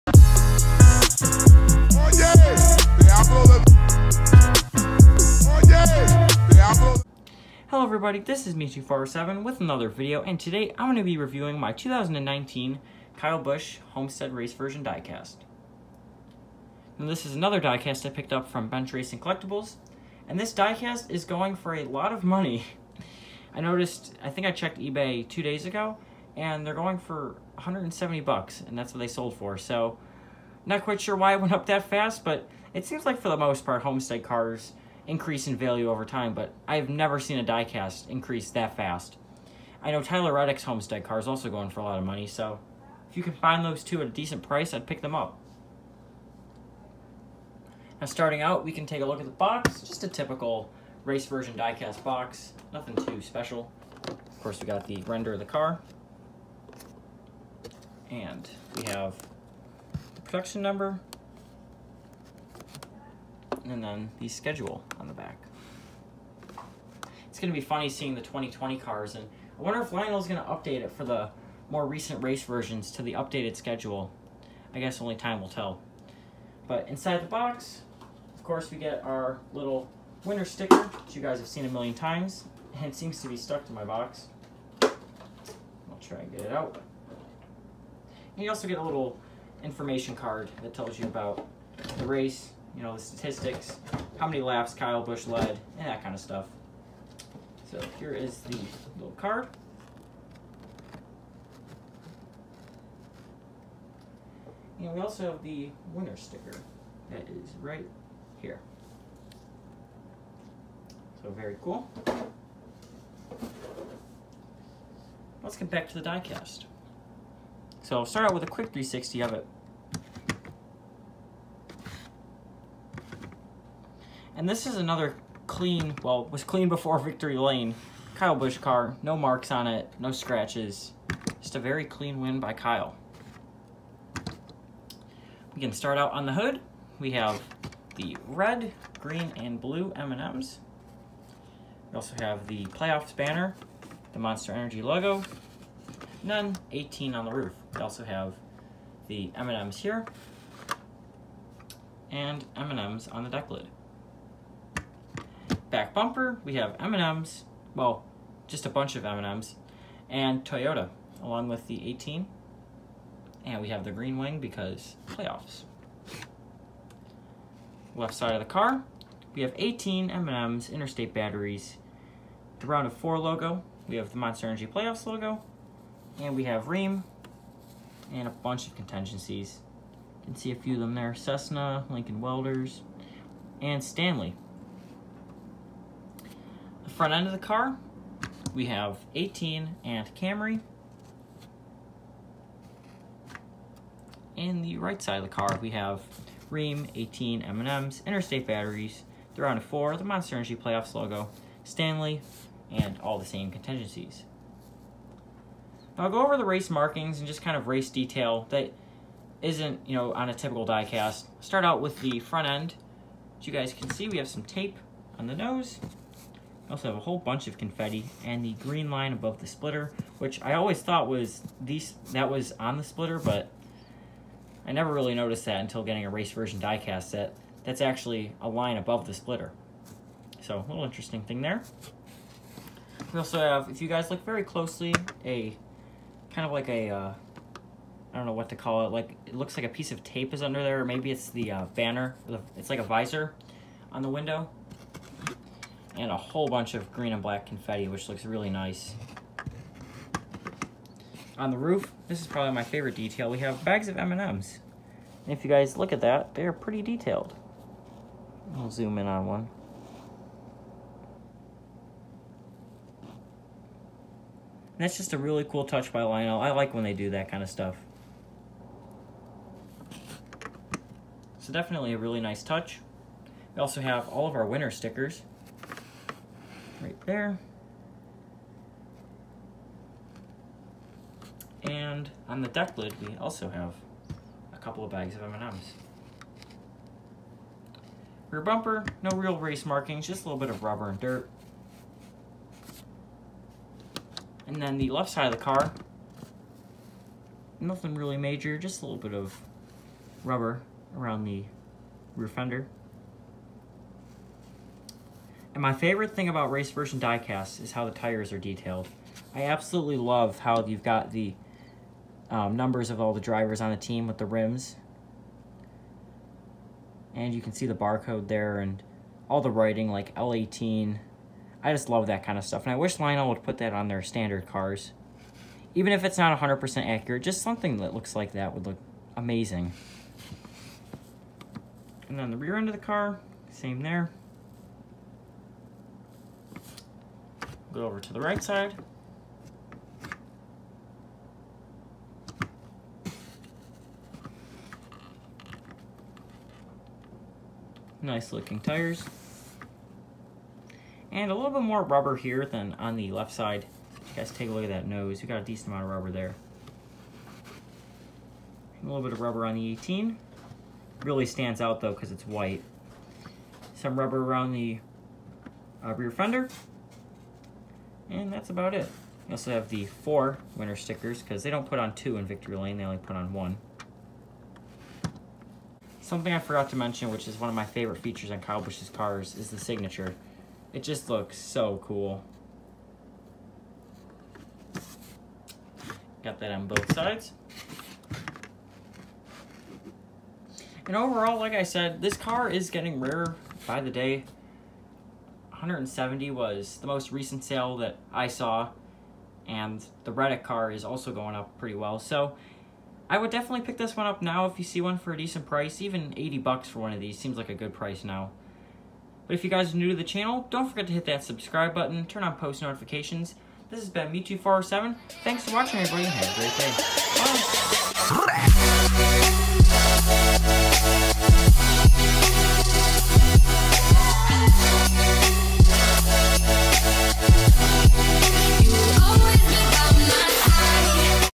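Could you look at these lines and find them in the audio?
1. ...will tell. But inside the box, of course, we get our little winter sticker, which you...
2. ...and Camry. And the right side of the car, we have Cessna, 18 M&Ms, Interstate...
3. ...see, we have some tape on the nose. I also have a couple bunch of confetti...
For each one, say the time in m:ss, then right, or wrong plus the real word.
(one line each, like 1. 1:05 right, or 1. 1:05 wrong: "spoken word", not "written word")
1. 1:15 right
2. 3:09 wrong: "Ream", not "Cessna"
3. 3:33 wrong: "whole", not "couple".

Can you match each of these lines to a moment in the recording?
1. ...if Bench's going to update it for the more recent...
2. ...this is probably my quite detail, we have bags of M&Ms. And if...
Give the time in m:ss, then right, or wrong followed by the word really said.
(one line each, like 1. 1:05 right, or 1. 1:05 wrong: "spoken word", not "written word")
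1. 1:09 wrong: "Lionel", not "Bench"
2. 4:12 wrong: "favorite", not "quite".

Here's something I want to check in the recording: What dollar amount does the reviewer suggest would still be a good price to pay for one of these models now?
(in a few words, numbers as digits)
$80.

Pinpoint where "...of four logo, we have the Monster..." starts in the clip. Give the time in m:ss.
2:52.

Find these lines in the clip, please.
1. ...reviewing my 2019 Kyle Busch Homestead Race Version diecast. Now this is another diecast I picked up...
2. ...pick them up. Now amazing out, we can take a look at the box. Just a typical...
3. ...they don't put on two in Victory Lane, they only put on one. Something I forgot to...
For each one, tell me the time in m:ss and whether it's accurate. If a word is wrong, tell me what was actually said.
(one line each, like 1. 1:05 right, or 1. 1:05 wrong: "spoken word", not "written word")
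1. 0:11 right
2. 0:44 wrong: "starting", not "amazing"
3. 6:11 right.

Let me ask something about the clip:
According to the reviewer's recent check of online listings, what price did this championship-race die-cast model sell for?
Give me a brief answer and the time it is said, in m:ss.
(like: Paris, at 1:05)
$170, at 0:27.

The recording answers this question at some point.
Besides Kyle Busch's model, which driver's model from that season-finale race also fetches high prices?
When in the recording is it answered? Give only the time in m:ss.
0:40.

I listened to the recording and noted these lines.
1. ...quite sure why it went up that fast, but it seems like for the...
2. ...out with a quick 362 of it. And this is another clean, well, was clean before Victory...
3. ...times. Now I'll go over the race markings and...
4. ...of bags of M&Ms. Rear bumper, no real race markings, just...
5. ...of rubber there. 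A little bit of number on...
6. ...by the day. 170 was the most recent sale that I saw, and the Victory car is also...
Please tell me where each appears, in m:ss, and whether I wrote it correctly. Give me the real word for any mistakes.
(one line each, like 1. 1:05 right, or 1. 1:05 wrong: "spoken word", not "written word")
1. 0:30 right
2. 1:58 wrong: "360", not "362"
3. 3:23 wrong: "contingencies", not "times"
4. 4:44 right
5. 5:55 wrong: "rubber", not "number"
6. 6:33 wrong: "Reddick", not "Victory".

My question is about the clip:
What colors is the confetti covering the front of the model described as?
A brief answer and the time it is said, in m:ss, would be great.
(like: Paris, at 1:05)
green and black, at 4:06.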